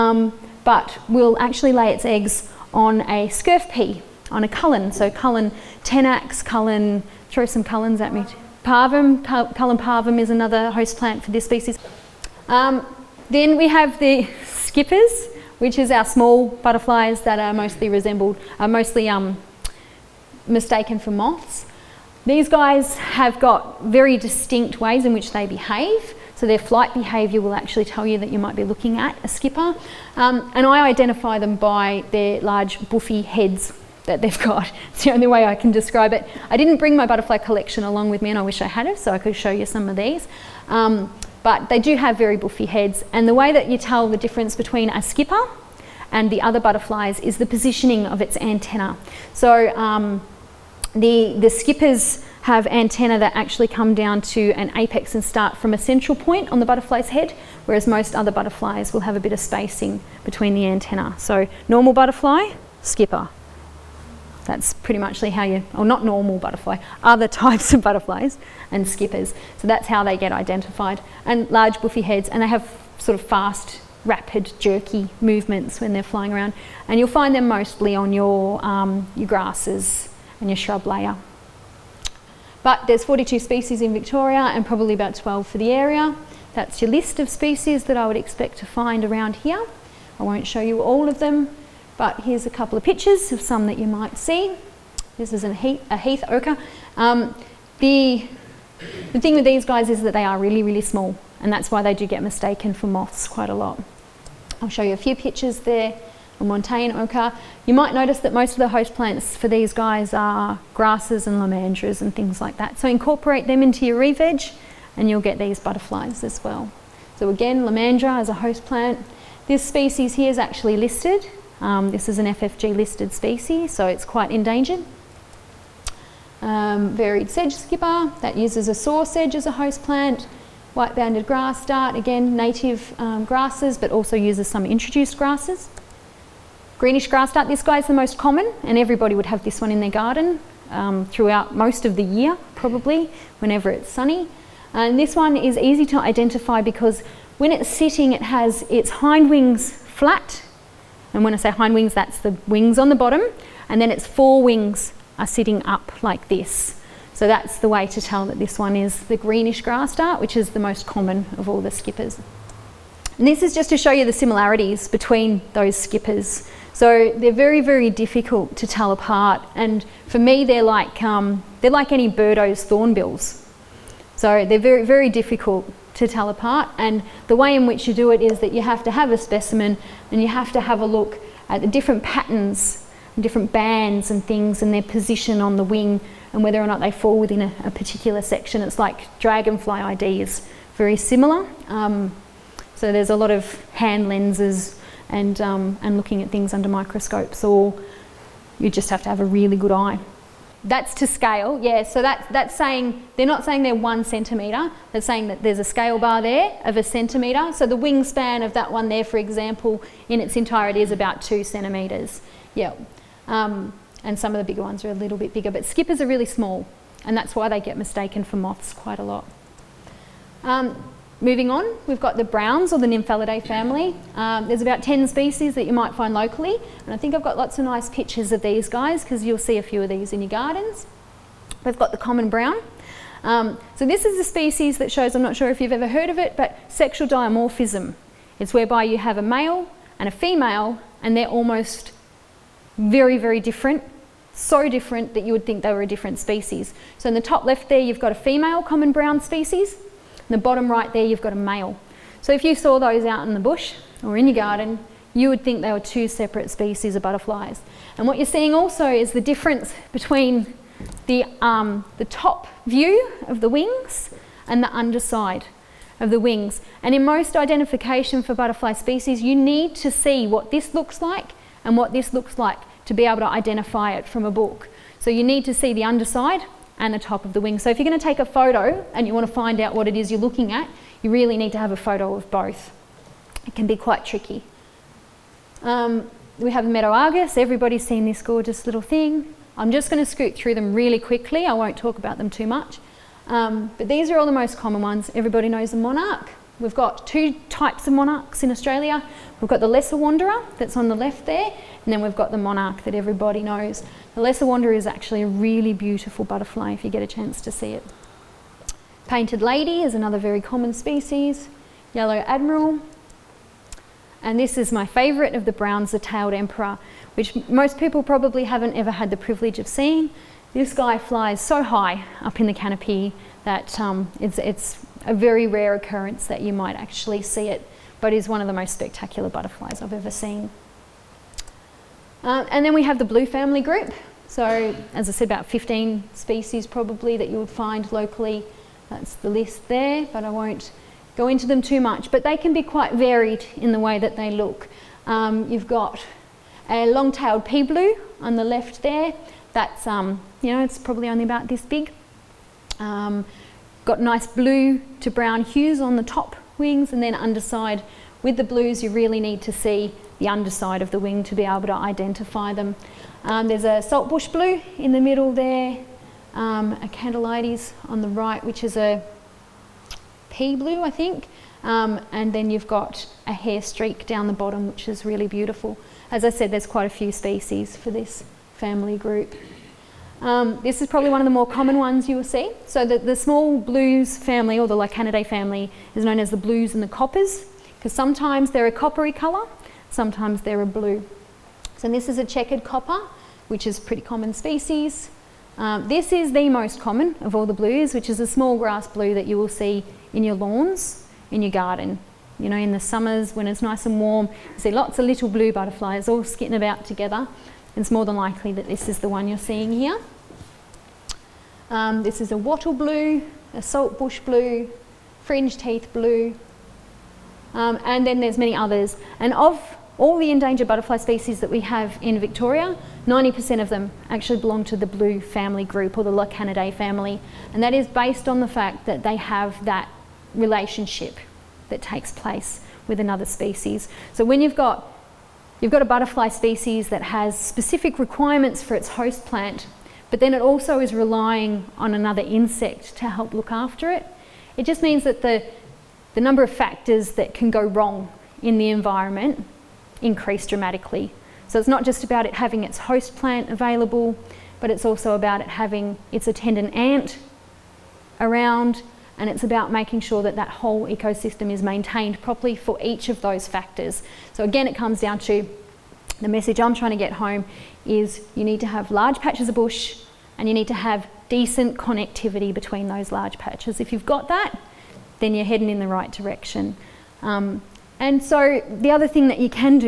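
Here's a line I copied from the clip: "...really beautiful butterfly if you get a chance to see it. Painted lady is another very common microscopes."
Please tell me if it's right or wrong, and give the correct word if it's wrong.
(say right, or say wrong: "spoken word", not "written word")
wrong: "species", not "microscopes".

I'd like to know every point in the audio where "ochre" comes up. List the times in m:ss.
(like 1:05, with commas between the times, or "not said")
1:36, 1:46.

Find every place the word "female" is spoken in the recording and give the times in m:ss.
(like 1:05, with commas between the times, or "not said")
4:00, 4:08.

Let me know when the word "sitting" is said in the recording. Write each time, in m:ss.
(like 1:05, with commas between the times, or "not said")
2:27, 2:35.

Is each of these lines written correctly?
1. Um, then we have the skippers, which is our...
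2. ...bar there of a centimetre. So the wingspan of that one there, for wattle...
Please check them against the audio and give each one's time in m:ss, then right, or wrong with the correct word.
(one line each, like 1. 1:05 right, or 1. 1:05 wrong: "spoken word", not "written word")
1. 0:12 right
2. 3:25 wrong: "example", not "wattle".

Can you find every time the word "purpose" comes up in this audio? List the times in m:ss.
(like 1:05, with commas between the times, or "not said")
not said.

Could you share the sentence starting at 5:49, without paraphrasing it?
That's, um, you know, it's probably only about this big.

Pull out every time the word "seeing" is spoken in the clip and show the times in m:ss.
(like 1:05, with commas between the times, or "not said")
4:18, 5:19, 6:49.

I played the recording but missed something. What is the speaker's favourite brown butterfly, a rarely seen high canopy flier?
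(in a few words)
Tailed emperor.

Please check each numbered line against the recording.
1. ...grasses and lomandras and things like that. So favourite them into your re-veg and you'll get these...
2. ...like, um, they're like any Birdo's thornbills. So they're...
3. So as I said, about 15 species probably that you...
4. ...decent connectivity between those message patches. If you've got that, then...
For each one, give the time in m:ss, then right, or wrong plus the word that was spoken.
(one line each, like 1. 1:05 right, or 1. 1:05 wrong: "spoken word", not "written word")
1. 1:50 wrong: "incorporate", not "favourite"
2. 2:50 right
3. 5:34 right
4. 7:51 wrong: "large", not "message".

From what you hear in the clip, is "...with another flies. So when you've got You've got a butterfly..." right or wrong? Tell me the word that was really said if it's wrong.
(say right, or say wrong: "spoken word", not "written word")
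wrong: "species", not "flies".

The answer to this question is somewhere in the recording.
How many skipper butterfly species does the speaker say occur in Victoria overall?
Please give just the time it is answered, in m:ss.
1:23.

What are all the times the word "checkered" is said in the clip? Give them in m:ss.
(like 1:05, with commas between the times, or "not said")
6:32.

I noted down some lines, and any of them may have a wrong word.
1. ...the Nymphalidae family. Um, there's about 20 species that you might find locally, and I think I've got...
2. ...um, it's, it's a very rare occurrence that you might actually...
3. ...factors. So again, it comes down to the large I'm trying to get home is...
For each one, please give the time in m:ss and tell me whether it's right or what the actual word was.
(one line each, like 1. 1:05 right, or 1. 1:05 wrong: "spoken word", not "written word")
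1. 3:42 wrong: "10", not "20"
2. 5:23 right
3. 7:43 wrong: "message", not "large".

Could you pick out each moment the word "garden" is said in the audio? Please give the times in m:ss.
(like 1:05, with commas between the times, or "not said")
2:19, 3:50, 4:14, 6:41.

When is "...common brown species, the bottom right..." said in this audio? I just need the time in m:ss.
4:08.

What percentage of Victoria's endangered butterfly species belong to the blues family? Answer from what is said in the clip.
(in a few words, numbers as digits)
90%.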